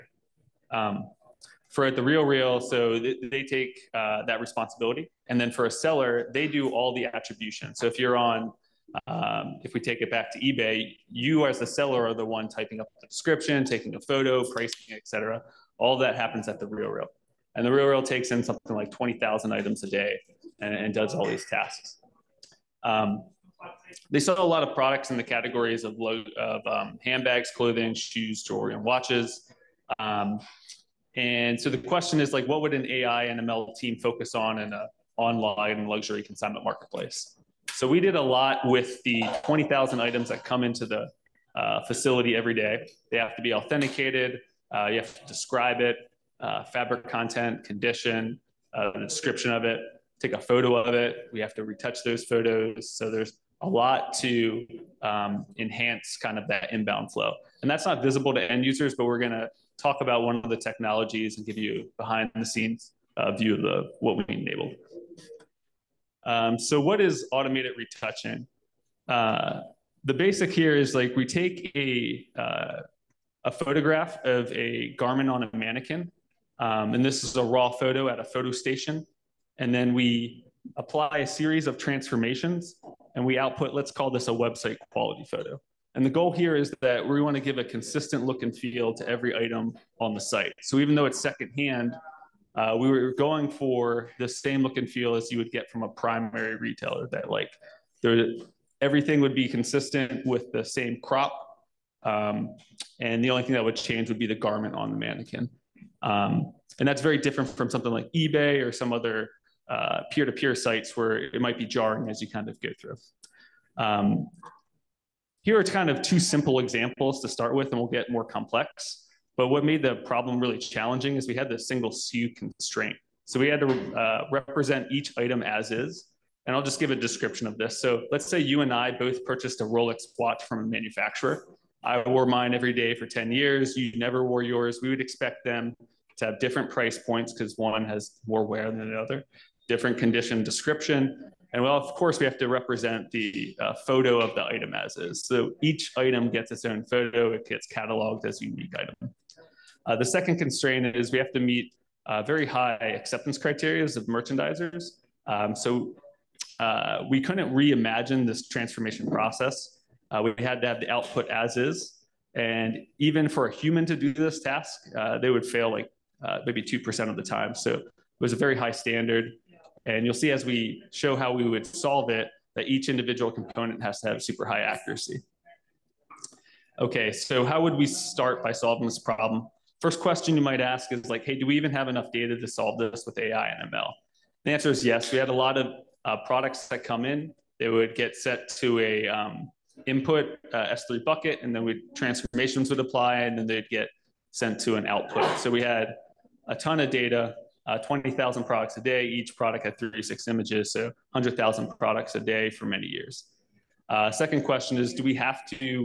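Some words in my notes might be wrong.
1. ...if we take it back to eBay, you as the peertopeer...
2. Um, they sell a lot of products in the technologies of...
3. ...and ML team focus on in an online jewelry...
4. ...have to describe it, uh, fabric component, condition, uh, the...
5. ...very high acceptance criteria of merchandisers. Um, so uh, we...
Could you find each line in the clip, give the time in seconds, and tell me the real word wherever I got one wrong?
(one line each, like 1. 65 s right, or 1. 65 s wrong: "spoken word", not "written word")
1. 9 s wrong: "seller", not "peertopeer"
2. 22 s wrong: "categories", not "technologies"
3. 33 s wrong: "luxury", not "jewelry"
4. 44 s wrong: "content", not "component"
5. 152 s right.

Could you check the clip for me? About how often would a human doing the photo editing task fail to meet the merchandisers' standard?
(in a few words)
2%.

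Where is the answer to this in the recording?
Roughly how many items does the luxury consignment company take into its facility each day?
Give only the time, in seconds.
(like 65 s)
18 s.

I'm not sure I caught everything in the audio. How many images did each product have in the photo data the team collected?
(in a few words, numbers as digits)
36.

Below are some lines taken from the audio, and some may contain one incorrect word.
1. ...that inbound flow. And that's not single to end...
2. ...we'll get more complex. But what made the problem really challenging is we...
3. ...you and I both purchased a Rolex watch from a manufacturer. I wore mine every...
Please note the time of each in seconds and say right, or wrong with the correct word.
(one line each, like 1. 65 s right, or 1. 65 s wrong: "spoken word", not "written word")
1. 56 s wrong: "visible", not "single"
2. 117 s right
3. 128 s right.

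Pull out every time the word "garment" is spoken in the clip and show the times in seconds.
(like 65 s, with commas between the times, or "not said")
74 s, 104 s.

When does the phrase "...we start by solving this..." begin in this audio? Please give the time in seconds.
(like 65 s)
177 s.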